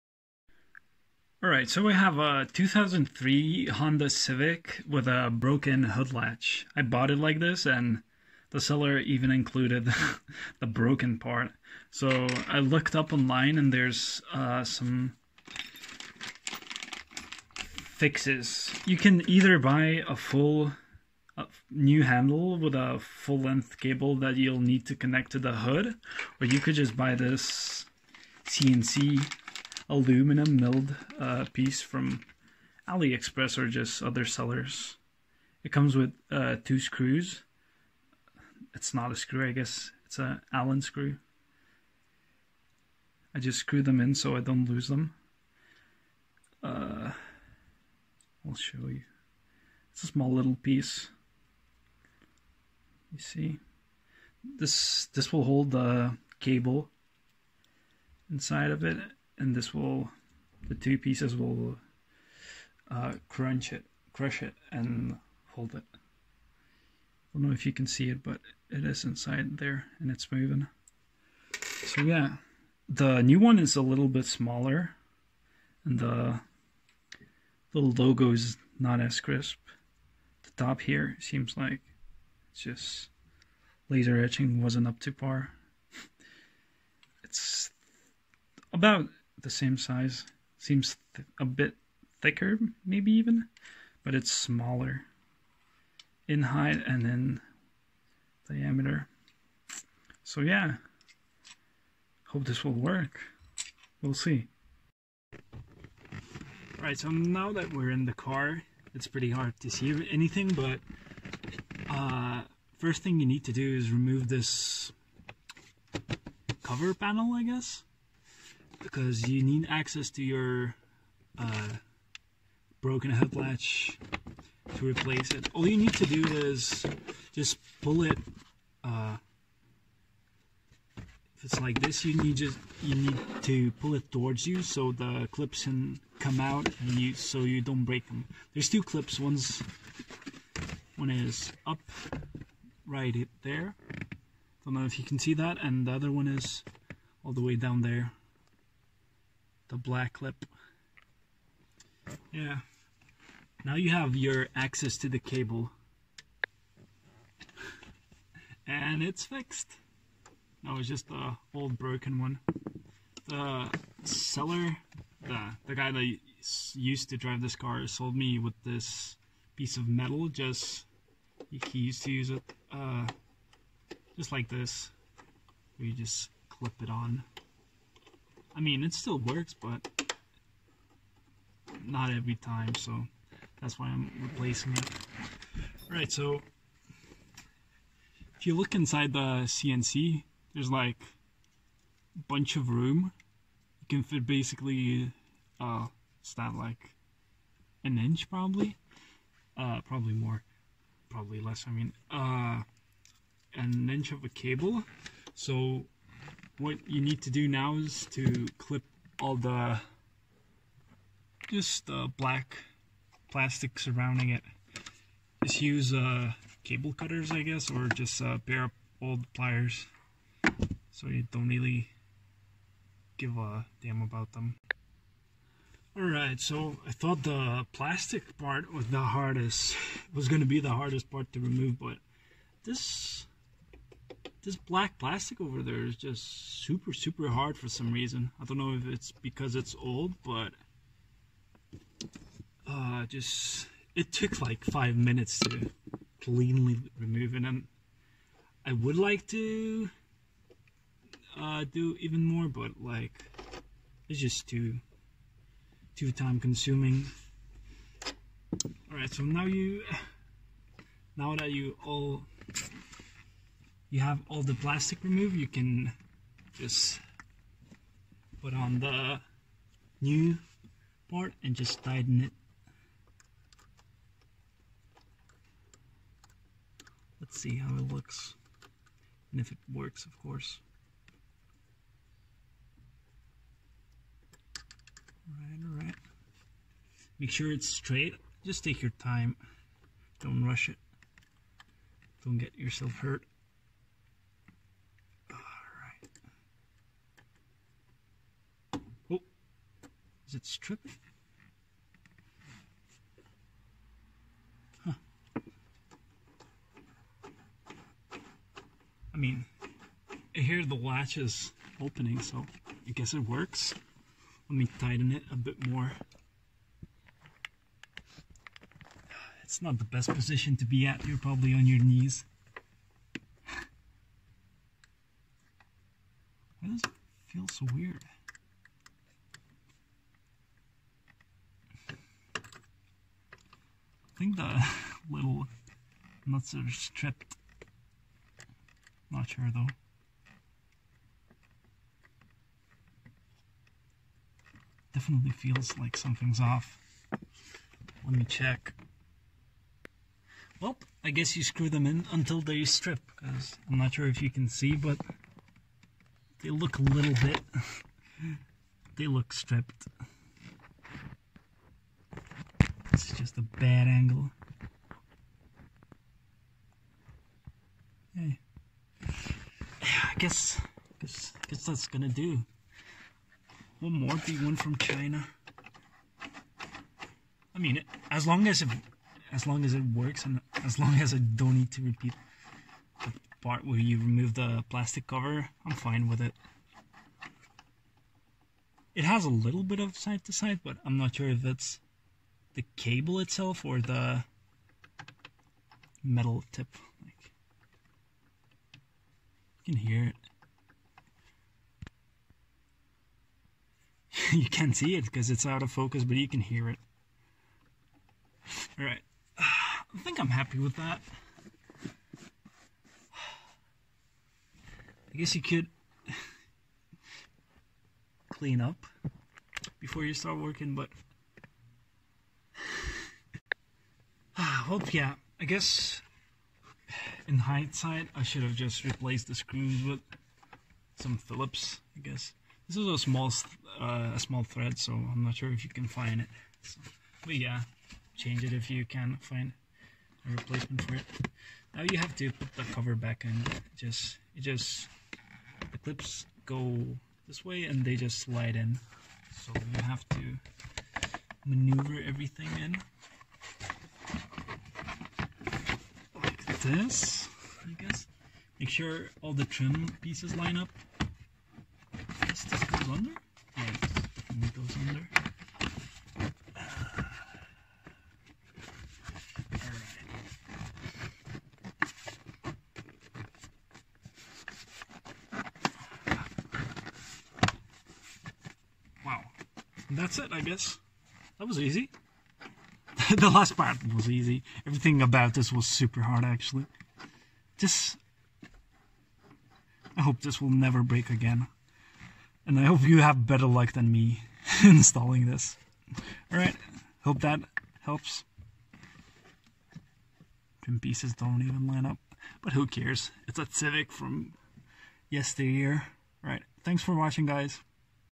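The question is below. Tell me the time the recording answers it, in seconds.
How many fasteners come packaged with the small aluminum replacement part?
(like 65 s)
36 s.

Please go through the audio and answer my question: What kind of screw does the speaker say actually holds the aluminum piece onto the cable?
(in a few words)
Allen screw.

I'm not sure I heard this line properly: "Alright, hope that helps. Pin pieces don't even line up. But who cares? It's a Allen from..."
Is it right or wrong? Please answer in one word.
wrong.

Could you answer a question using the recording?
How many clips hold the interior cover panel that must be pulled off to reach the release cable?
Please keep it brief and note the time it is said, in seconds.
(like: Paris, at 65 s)
2, at 138 s.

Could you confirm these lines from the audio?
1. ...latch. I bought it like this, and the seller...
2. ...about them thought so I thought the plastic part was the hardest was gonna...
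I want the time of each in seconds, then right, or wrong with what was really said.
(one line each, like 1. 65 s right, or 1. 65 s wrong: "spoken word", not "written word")
1. 6 s right
2. 224 s wrong: "alright", not "thought".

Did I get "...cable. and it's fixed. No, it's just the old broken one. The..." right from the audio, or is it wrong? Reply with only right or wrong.
right.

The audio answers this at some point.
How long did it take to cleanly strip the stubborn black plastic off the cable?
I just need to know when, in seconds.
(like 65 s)
244 s.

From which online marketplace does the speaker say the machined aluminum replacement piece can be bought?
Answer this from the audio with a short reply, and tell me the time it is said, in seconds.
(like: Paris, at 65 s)
AliExpress, at 32 s.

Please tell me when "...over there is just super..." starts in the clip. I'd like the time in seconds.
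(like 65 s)
235 s.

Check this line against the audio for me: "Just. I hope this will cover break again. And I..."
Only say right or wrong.
wrong.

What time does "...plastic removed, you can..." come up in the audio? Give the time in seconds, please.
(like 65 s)
264 s.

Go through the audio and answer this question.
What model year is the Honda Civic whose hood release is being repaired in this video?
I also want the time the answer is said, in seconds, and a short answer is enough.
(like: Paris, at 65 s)
2003, at 2 s.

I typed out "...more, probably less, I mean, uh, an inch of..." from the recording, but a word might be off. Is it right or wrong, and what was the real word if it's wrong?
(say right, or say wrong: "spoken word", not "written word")
right.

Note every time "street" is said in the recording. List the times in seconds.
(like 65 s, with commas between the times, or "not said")
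not said.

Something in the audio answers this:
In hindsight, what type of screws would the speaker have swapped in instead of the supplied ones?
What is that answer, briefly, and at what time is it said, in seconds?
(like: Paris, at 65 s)
Phillips, at 431 s.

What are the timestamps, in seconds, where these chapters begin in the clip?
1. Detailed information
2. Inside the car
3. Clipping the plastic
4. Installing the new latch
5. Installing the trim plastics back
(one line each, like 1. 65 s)
1. 20 s
2. 104 s
3. 186 s
4. 260 s
5. 440 s.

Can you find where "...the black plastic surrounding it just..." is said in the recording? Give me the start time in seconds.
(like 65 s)
211 s.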